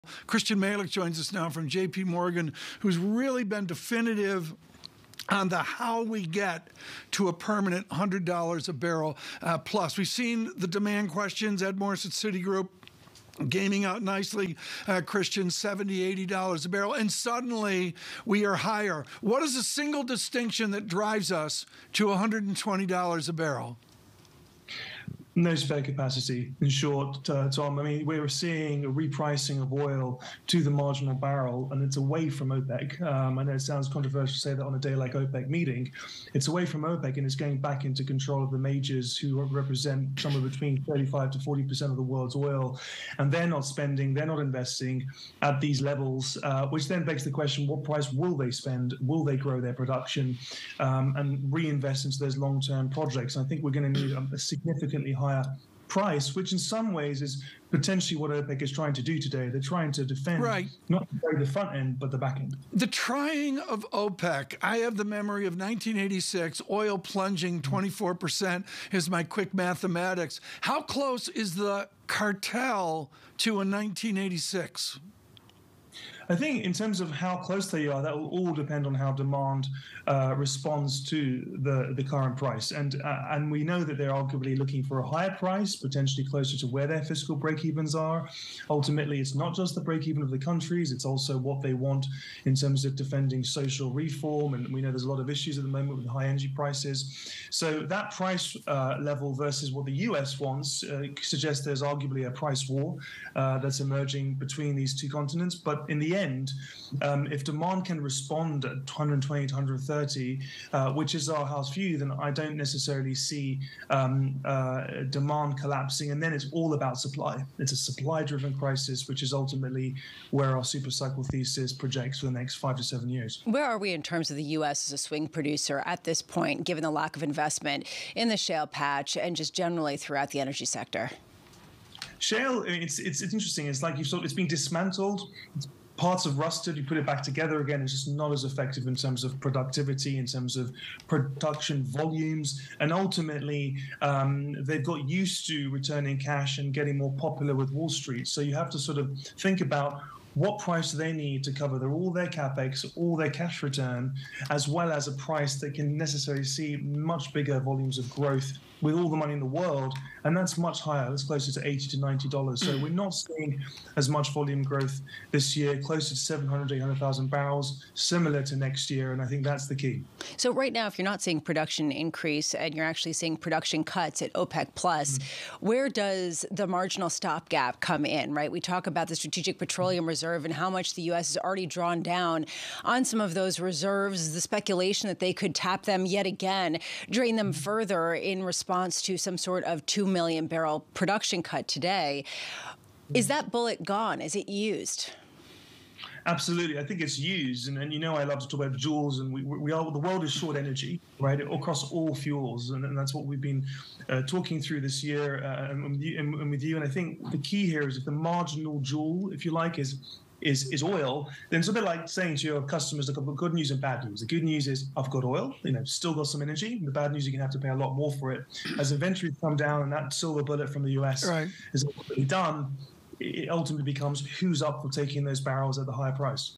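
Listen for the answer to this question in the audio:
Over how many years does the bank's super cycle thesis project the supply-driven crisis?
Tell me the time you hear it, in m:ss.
2:02.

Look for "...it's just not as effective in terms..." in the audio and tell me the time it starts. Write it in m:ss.
2:17.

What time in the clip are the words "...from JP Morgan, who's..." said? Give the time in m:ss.
0:01.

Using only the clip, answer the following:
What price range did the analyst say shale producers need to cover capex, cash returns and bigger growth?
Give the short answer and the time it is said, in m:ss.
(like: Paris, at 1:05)
$80 to $90, at 2:41.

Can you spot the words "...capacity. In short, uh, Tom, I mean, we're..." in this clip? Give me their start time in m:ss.
0:25.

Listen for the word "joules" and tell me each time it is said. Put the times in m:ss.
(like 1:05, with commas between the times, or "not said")
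3:18, 3:28.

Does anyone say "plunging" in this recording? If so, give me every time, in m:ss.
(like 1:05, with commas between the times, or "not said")
1:06.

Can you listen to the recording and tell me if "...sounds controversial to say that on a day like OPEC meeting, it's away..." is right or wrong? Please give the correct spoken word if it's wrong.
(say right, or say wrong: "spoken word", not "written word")
right.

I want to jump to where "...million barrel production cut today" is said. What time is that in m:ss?
3:10.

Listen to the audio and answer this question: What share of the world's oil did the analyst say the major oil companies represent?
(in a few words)
35 to 40 percent.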